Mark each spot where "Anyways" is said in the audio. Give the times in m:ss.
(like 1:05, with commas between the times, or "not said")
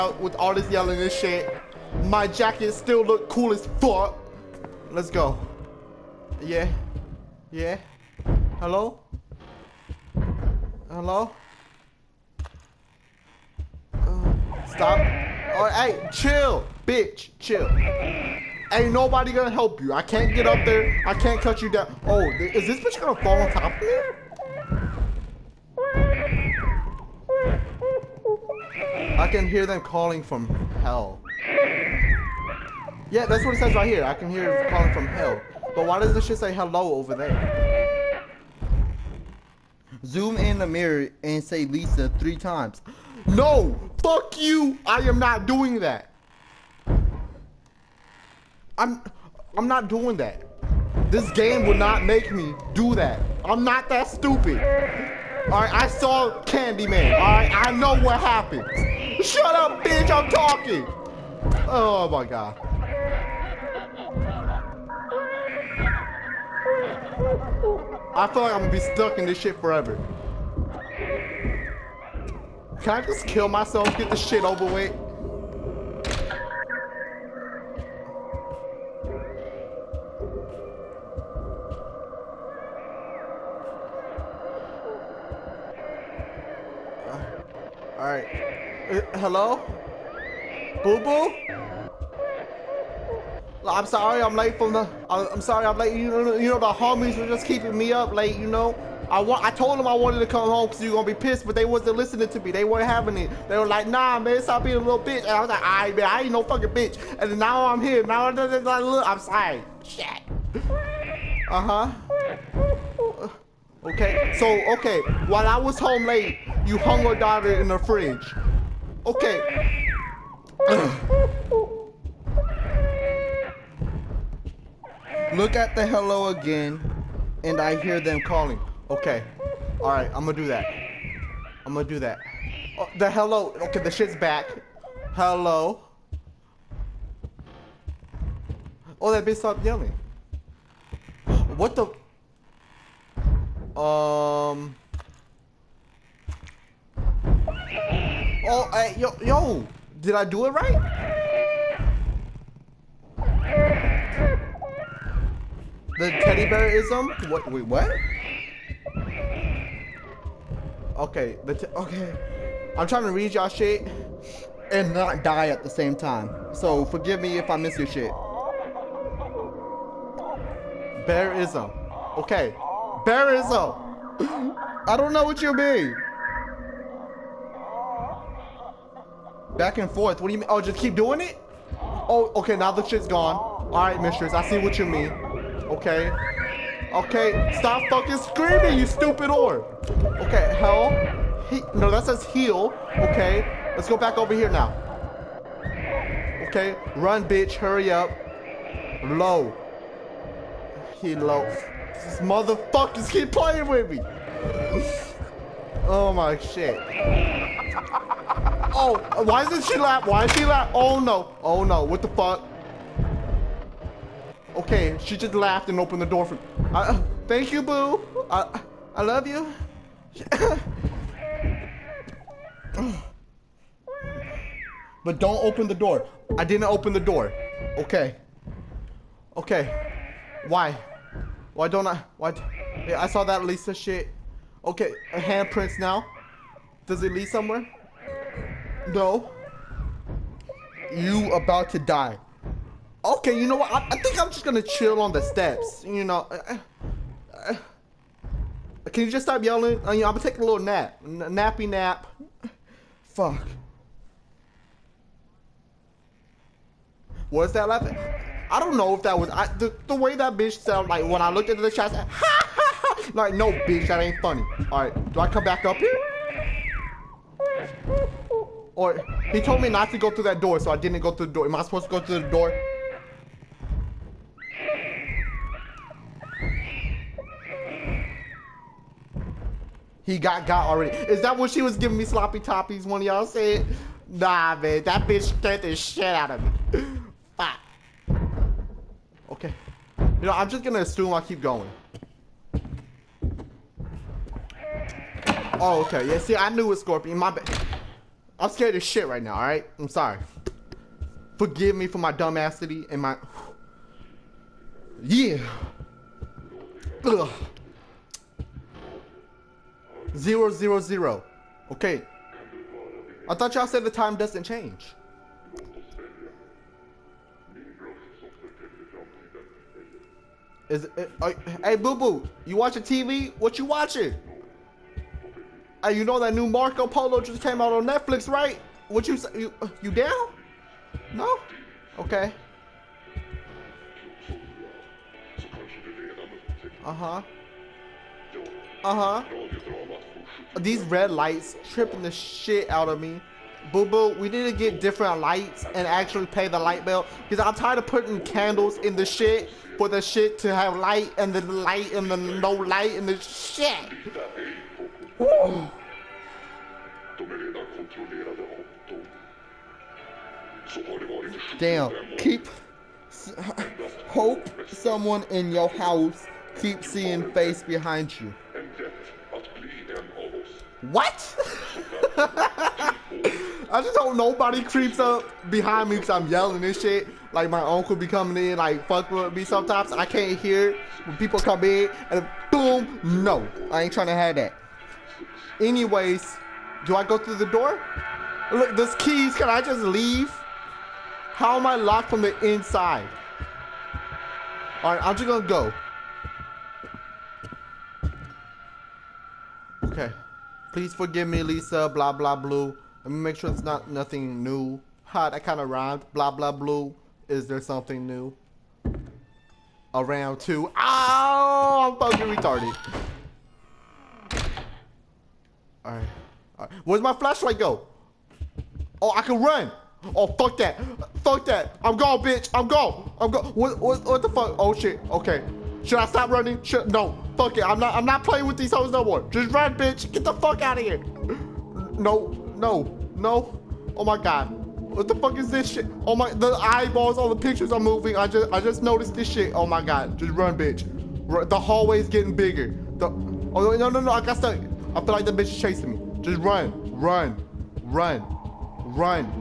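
6:25.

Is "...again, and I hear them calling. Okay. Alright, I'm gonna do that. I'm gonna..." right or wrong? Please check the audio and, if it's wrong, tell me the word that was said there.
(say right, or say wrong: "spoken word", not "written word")
right.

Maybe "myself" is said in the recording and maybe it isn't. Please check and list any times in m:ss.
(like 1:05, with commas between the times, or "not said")
1:13.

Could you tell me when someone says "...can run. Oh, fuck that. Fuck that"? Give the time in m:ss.
6:59.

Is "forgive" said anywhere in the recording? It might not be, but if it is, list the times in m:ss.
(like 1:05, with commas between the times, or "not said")
2:46, 5:01, 6:40.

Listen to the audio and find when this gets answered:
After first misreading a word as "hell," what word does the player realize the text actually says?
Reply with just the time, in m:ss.
3:12.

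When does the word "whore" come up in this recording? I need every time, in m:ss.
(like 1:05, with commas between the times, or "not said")
3:09.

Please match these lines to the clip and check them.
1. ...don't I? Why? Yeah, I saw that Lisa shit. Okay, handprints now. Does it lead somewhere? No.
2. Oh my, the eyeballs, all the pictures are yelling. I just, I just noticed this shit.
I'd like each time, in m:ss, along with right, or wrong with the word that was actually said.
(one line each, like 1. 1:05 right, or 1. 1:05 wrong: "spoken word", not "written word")
1. 3:51 right
2. 7:16 wrong: "moving", not "yelling".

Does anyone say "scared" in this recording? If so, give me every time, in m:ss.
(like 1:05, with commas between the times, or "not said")
4:45, 4:58.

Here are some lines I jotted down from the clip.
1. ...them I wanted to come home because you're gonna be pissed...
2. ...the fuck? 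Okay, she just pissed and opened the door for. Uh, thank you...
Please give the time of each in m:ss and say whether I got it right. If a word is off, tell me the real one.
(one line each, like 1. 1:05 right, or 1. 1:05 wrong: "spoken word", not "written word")
1. 1:39 right
2. 3:31 wrong: "laughed", not "pissed".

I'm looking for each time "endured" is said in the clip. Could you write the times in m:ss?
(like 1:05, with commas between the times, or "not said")
not said.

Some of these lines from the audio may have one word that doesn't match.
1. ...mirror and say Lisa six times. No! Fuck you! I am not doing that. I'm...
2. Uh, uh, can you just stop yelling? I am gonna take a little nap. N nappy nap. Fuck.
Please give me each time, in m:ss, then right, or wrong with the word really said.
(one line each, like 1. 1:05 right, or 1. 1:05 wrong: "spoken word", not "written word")
1. 0:40 wrong: "three", not "six"
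2. 4:06 right.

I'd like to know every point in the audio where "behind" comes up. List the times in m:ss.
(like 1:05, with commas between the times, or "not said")
6:07, 6:15.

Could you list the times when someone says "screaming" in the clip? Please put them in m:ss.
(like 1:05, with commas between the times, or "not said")
3:08.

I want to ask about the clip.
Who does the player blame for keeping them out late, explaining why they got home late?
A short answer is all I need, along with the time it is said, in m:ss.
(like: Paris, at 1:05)
the homies, at 1:36.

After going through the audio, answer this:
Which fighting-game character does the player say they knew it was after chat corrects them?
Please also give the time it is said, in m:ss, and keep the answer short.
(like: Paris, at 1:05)
Scorpion, at 4:56.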